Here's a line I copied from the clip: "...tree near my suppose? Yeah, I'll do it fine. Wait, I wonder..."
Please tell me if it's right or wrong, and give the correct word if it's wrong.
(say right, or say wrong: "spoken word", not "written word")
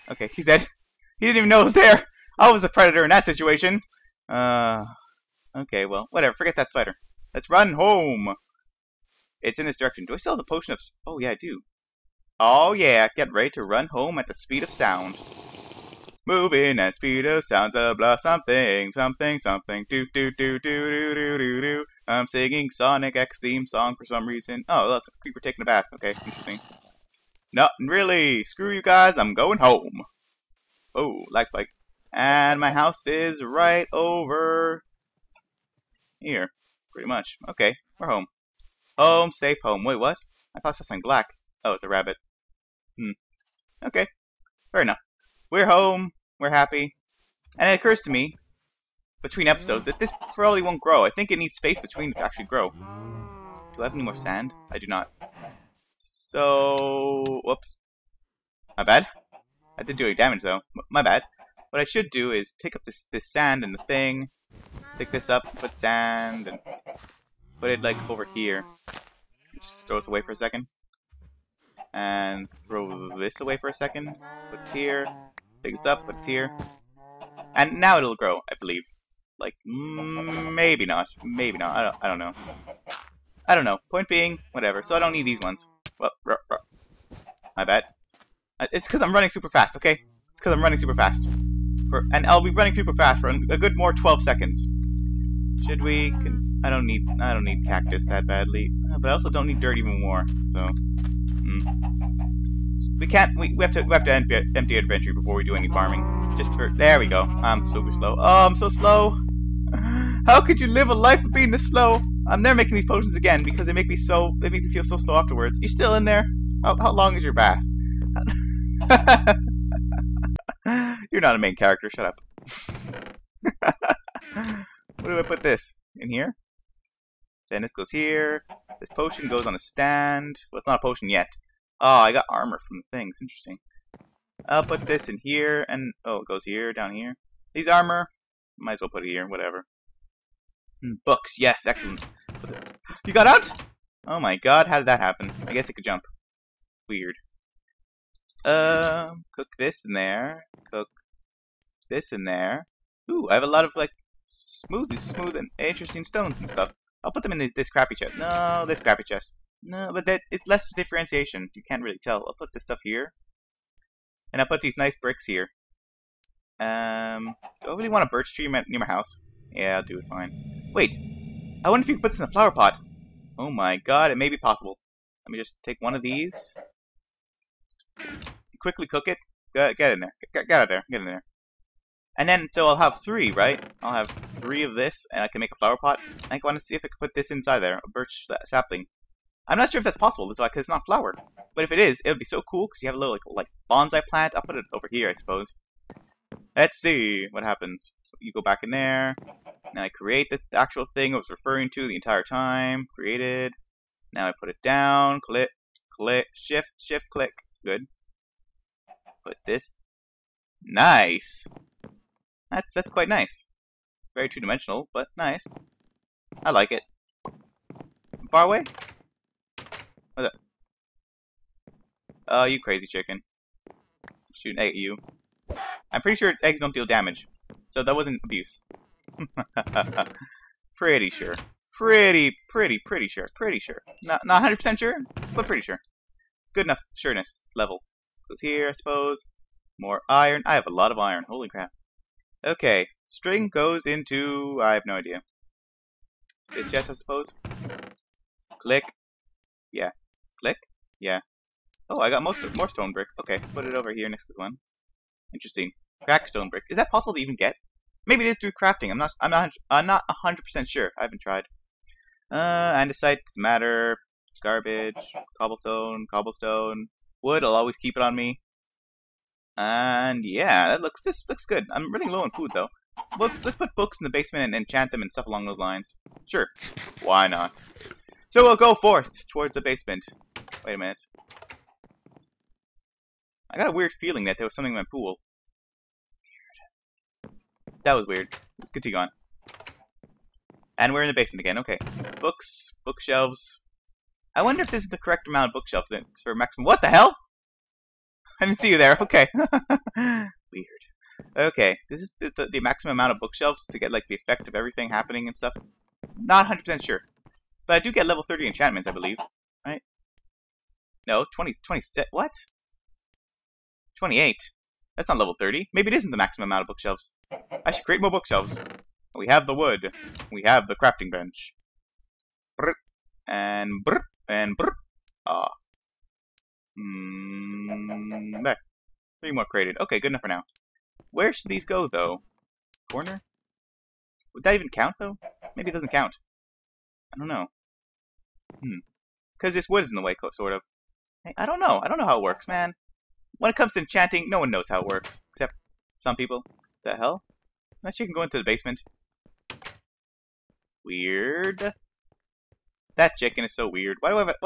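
wrong: "house", not "suppose".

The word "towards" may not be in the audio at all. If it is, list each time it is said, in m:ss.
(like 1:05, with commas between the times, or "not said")
4:39.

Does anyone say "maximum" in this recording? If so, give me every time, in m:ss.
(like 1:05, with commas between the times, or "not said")
4:56, 5:02, 5:16.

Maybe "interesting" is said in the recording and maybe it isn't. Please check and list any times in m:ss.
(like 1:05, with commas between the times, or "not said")
0:26, 2:13, 2:35, 4:15.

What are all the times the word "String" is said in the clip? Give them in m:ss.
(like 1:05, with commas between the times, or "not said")
4:03.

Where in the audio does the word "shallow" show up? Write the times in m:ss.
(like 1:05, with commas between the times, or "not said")
not said.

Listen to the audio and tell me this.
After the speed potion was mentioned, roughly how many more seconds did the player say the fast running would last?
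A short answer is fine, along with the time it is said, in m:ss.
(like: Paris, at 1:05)
12, at 1:33.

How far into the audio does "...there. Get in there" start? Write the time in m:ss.
3:00.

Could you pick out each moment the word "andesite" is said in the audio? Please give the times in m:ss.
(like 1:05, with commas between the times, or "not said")
4:22.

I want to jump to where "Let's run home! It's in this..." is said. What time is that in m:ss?
0:07.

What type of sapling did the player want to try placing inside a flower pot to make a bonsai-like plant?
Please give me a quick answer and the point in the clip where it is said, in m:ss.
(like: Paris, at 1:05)
Birch sapling, at 3:07.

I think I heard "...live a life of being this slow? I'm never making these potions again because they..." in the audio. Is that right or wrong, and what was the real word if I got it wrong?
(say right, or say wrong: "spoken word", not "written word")
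right.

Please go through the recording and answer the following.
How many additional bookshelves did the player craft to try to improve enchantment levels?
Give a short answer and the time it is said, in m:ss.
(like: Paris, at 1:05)
3, at 5:29.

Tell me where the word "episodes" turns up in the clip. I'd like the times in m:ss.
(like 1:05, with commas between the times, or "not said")
0:49.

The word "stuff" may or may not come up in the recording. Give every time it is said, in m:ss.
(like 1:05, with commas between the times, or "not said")
2:36, 2:42, 4:35, 5:05.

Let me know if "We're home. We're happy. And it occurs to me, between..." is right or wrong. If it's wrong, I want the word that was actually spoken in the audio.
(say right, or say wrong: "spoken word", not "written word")
right.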